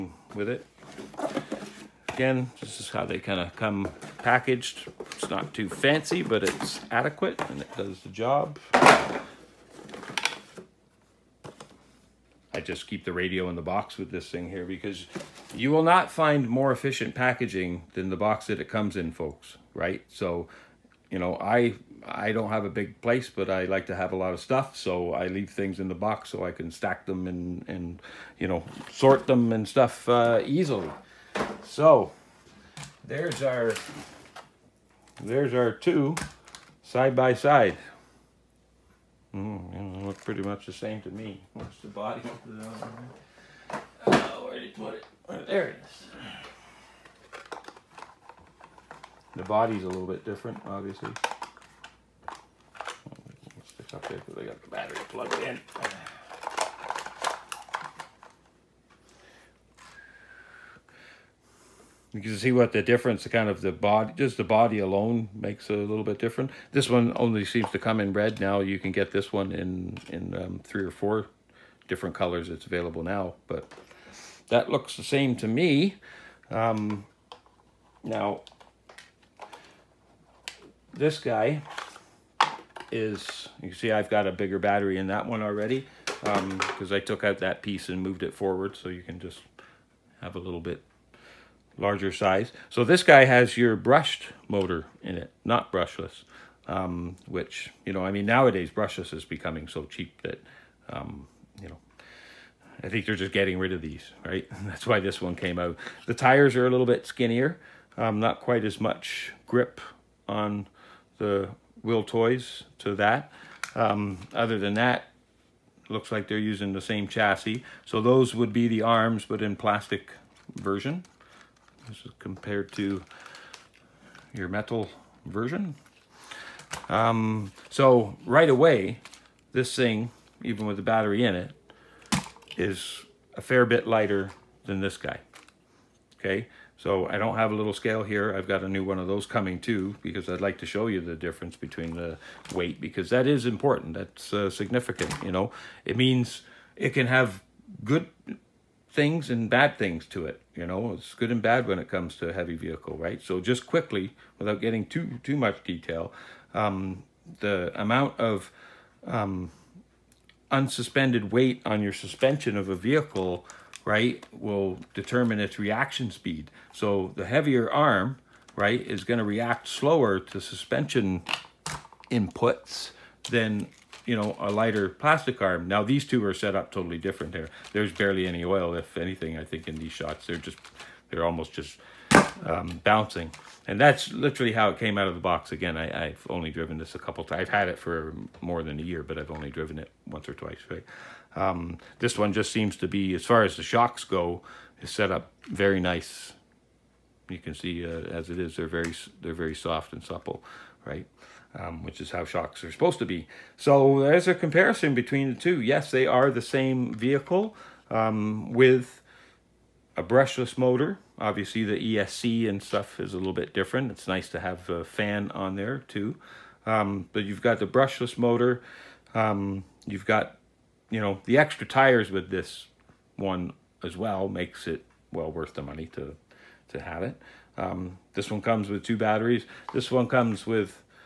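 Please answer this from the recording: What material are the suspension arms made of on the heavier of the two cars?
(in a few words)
Metal.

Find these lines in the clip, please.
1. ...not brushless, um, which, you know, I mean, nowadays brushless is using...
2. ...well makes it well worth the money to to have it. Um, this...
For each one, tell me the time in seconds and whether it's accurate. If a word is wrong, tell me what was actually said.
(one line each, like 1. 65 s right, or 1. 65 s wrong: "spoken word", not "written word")
1. 95 s wrong: "becoming", not "using"
2. 223 s right.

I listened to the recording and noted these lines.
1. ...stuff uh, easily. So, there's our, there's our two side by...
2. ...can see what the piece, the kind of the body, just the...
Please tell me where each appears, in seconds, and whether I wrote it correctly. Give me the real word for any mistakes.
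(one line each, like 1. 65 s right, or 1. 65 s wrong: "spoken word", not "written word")
1. 29 s right
2. 62 s wrong: "difference", not "piece".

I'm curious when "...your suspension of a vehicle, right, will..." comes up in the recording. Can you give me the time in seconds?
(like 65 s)
161 s.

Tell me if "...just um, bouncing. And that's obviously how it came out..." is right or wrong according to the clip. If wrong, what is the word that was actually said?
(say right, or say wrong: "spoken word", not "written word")
wrong: "literally", not "obviously".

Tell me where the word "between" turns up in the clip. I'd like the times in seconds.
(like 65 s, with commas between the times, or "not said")
141 s, 204 s.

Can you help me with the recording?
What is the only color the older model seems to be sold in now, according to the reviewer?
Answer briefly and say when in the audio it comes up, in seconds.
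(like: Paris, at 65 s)
Red, at 68 s.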